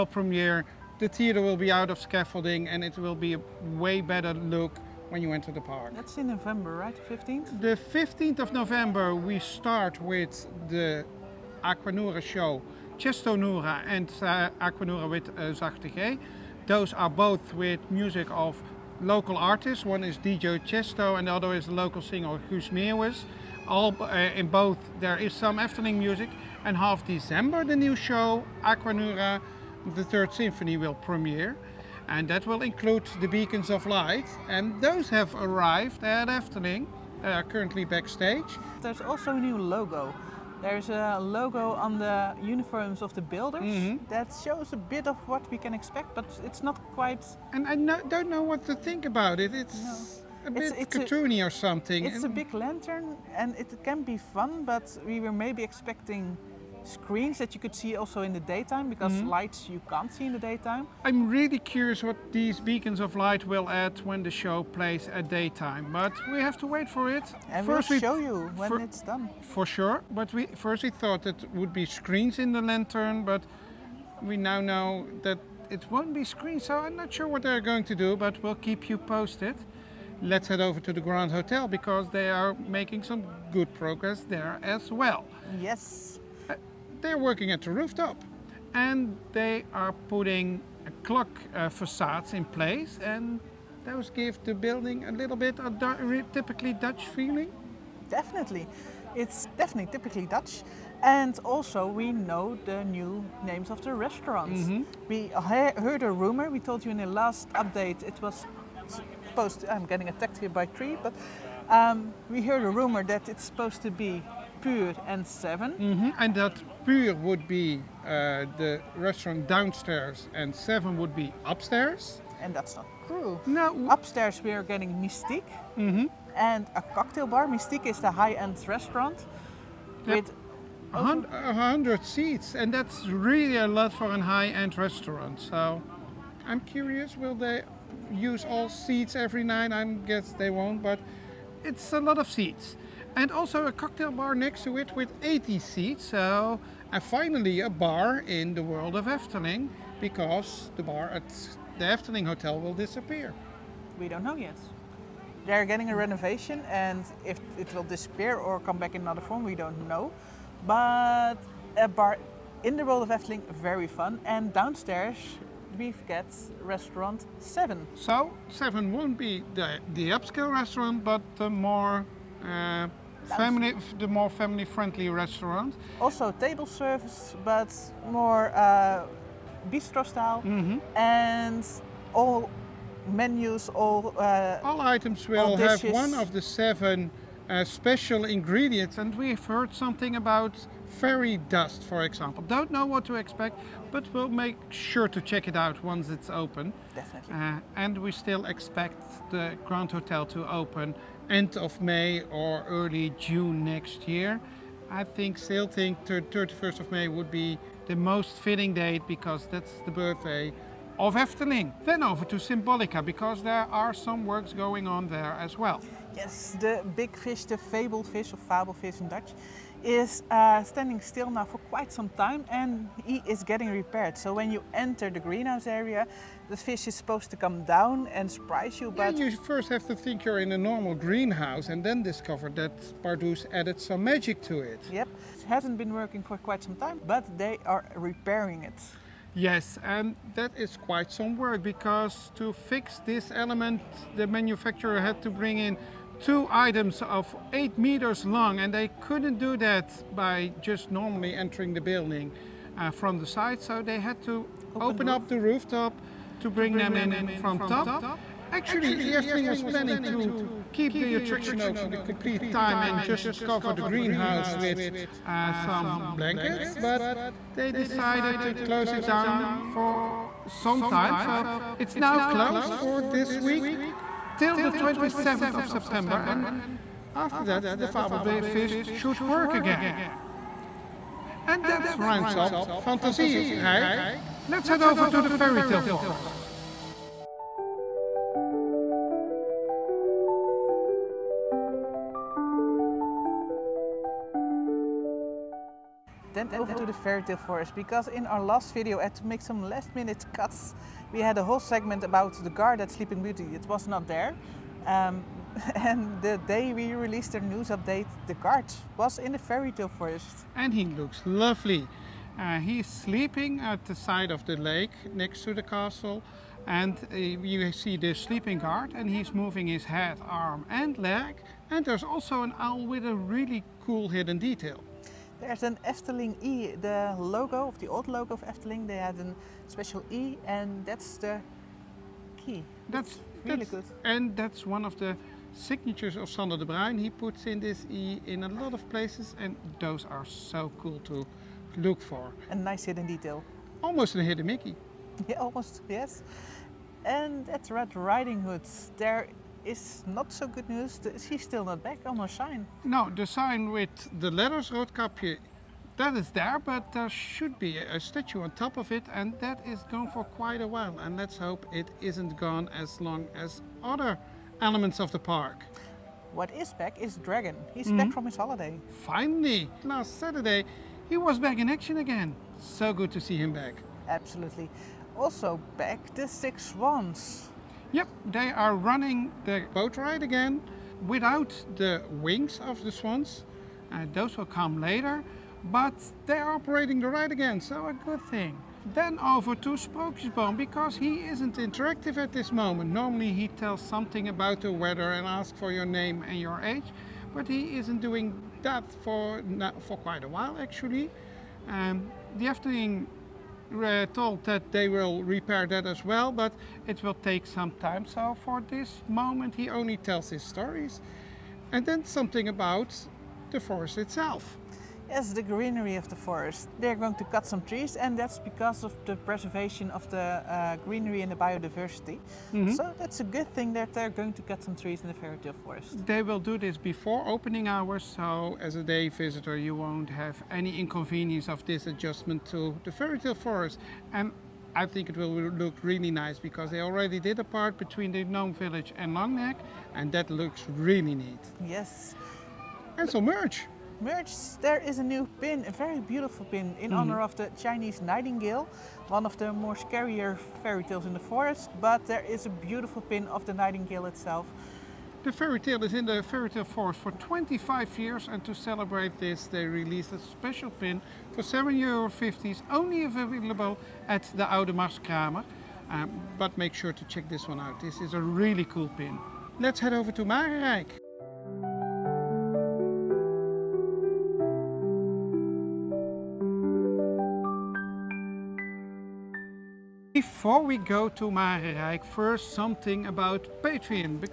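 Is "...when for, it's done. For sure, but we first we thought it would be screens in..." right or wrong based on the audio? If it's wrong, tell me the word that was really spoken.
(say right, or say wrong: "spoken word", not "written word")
right.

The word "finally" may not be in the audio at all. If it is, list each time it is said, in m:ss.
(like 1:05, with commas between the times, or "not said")
2:27, 6:09.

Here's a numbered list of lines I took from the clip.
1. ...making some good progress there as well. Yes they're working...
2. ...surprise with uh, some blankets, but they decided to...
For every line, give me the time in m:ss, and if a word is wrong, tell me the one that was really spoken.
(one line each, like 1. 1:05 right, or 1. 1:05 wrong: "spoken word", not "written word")
1. 1:22 right
2. 4:23 wrong: "greenhouse", not "surprise".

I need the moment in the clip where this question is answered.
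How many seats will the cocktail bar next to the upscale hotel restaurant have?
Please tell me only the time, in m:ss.
2:25.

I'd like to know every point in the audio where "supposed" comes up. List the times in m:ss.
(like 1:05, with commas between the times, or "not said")
1:49, 1:53, 3:46.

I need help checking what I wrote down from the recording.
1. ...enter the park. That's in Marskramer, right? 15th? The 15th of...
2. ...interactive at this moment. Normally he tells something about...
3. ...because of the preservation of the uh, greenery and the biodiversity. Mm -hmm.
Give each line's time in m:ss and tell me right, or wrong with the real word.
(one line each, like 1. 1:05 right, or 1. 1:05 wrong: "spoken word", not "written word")
1. 0:05 wrong: "November", not "Marskramer"
2. 6:31 right
3. 6:58 right.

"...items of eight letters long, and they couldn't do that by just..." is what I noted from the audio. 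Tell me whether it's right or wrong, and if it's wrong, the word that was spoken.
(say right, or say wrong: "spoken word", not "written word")
wrong: "meters", not "letters".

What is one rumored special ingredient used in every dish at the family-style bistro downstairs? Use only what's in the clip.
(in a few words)
Fairy dust.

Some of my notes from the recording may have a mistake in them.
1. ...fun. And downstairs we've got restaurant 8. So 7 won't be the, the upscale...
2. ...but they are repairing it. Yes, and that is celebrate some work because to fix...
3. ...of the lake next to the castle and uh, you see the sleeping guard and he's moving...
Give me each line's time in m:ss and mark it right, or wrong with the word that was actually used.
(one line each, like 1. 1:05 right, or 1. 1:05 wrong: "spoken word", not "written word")
1. 2:43 wrong: "7", not "8"
2. 3:57 wrong: "quite", not "celebrate"
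3. 5:14 right.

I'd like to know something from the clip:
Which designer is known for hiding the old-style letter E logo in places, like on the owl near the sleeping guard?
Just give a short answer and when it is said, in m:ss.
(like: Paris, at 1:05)
Sander de Bruijne, at 5:36.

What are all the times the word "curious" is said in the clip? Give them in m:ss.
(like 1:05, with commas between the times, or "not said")
1:01, 2:16.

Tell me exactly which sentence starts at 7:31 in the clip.
But there is a beautiful pin of the nightingale itself.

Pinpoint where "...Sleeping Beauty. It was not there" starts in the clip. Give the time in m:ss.
5:02.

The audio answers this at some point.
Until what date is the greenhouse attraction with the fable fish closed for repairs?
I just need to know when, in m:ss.
4:34.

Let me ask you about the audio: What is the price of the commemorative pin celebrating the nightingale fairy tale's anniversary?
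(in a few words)
7 euro.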